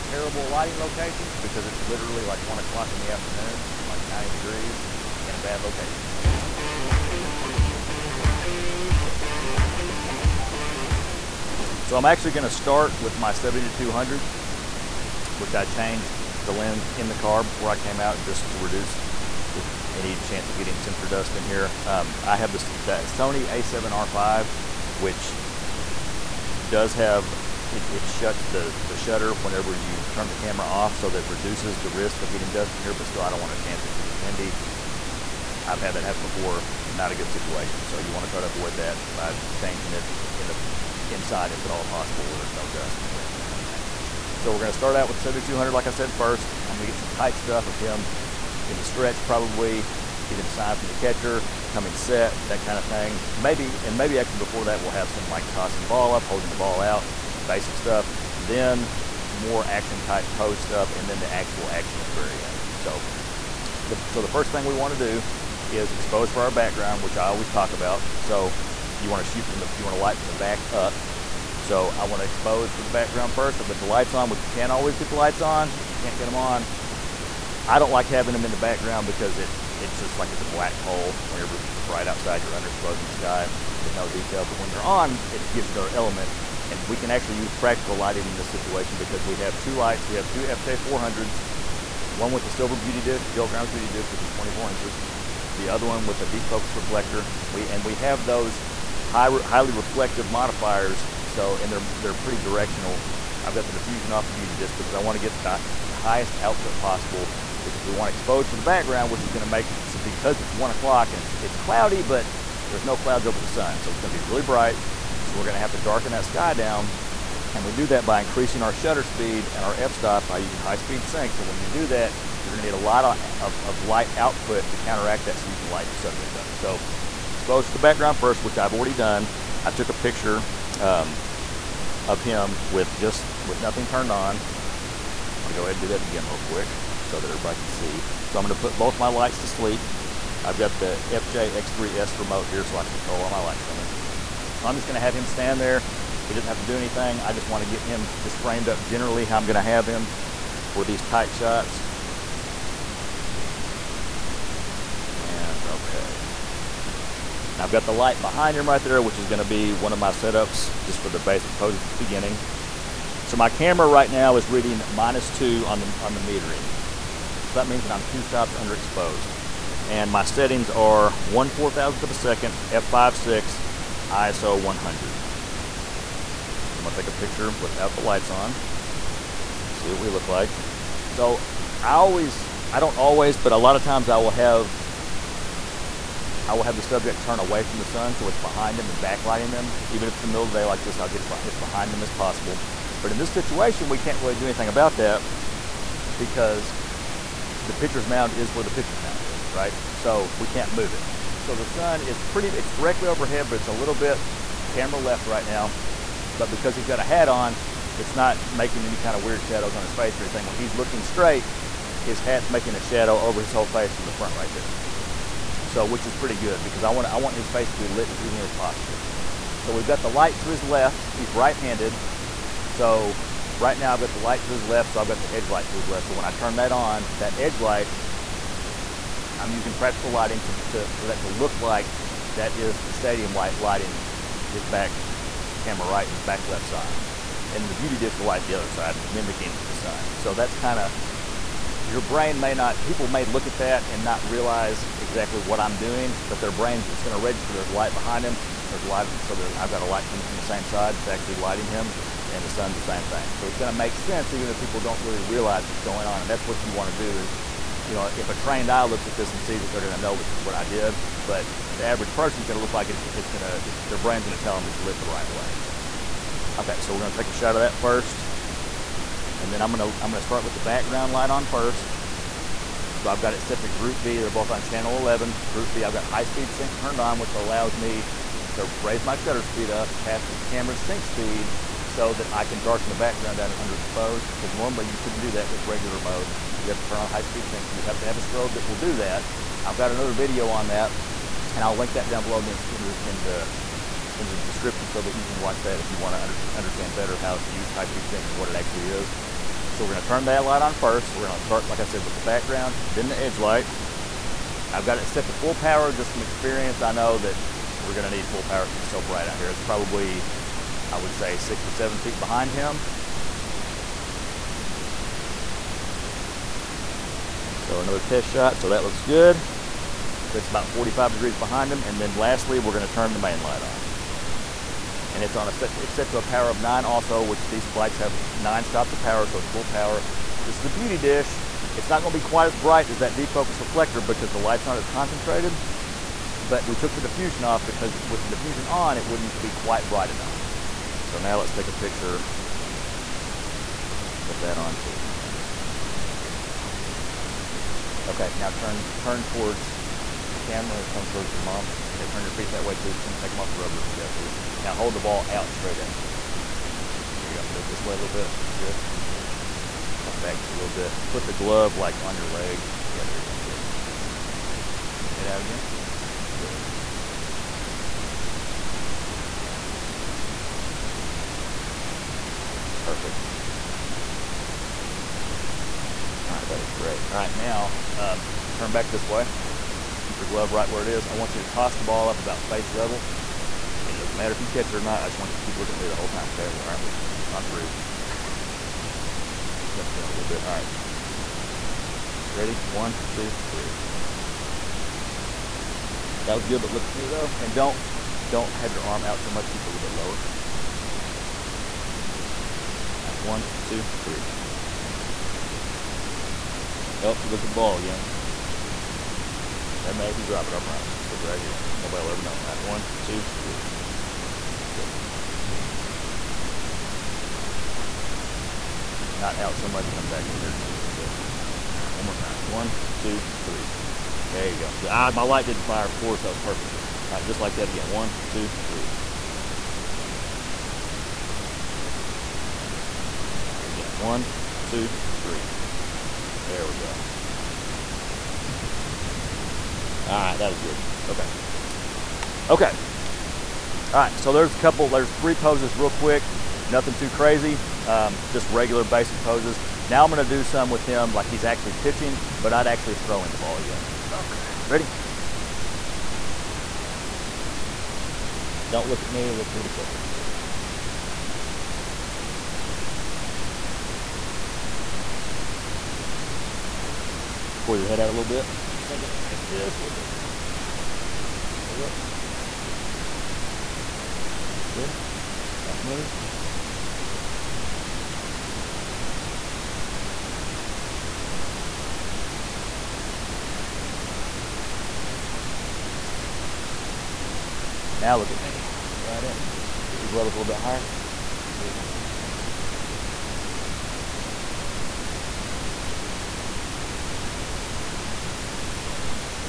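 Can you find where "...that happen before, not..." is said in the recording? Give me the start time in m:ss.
0:35.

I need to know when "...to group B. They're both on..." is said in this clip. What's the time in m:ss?
4:33.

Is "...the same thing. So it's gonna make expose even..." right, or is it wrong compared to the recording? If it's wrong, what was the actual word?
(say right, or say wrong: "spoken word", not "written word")
wrong: "sense", not "expose".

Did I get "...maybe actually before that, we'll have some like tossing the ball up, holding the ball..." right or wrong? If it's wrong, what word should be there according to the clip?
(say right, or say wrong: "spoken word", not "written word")
right.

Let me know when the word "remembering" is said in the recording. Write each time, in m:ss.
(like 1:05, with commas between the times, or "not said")
not said.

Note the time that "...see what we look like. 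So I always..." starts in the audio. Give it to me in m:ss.
2:59.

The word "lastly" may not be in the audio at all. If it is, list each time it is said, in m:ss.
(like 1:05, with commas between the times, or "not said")
5:22.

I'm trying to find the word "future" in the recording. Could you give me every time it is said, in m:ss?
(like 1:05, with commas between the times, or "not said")
not said.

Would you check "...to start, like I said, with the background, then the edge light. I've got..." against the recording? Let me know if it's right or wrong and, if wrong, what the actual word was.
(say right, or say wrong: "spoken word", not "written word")
right.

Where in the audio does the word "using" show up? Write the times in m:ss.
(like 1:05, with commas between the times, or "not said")
2:00, 3:49.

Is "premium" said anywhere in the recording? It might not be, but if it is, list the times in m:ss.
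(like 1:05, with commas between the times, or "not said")
not said.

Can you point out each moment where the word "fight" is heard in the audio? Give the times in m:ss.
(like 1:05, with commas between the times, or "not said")
not said.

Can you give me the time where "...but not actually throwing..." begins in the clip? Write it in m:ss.
7:32.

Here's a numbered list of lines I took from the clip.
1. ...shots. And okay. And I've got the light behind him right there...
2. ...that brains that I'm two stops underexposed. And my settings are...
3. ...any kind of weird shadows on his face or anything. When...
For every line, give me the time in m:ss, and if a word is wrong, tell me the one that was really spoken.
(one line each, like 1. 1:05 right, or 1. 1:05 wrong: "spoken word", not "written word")
1. 2:31 right
2. 2:47 wrong: "means", not "brains"
3. 3:28 right.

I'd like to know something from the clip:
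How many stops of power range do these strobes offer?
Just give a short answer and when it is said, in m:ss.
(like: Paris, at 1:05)
9, at 5:28.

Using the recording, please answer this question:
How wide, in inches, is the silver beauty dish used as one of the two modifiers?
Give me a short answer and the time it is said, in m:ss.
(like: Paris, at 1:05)
24 inches, at 1:34.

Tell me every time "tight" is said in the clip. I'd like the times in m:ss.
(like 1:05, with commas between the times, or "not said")
0:47, 2:31.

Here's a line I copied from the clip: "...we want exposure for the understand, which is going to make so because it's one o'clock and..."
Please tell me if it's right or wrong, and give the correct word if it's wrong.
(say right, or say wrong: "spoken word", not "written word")
wrong: "background", not "understand".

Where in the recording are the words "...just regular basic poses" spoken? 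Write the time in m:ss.
7:28.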